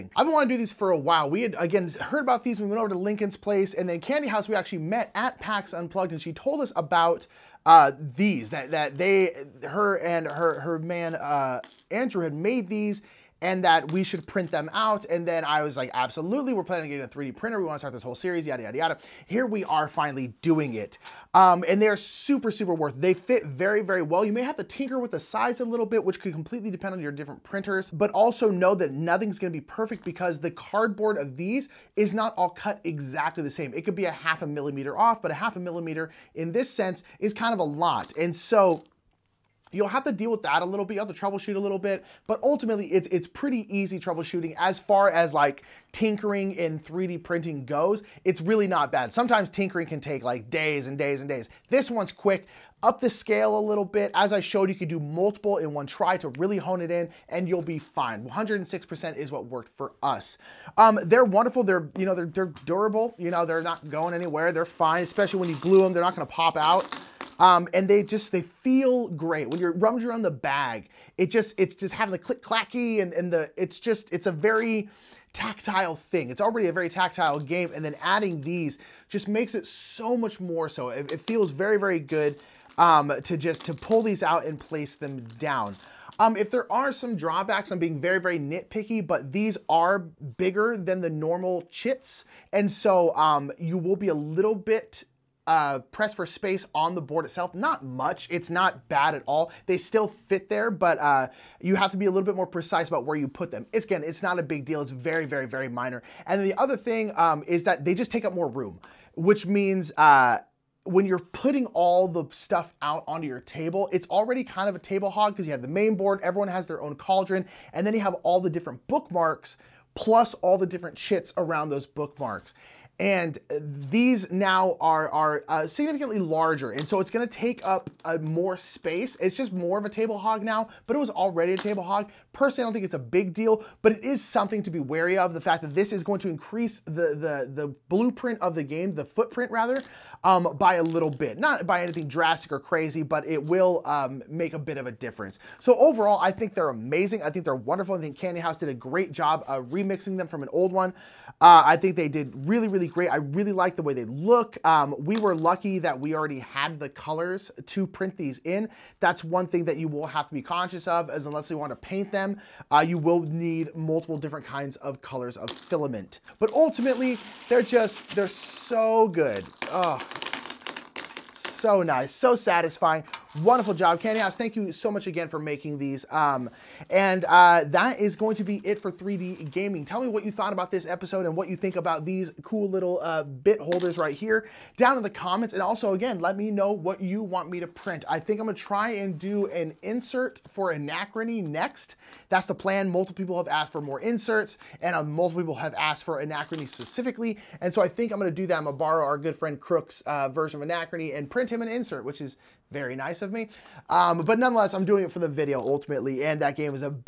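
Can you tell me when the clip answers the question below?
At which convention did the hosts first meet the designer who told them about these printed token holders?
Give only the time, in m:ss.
0:05.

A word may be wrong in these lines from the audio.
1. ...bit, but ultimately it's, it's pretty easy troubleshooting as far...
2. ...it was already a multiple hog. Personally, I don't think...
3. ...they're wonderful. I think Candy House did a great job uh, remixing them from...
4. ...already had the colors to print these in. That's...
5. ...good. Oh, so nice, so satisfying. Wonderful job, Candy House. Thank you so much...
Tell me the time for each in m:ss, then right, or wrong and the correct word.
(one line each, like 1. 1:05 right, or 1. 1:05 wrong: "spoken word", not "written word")
1. 0:41 right
2. 2:10 wrong: "table", not "multiple"
3. 2:27 right
4. 2:36 right
5. 2:49 right.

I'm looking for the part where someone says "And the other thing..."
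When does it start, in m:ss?
1:46.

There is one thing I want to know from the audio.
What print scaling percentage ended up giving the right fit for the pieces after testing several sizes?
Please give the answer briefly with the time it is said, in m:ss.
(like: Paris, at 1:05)
106%, at 0:58.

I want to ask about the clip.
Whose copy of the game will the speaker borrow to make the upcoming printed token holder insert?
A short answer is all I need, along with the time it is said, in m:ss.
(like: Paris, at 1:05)
Crook, at 3:19.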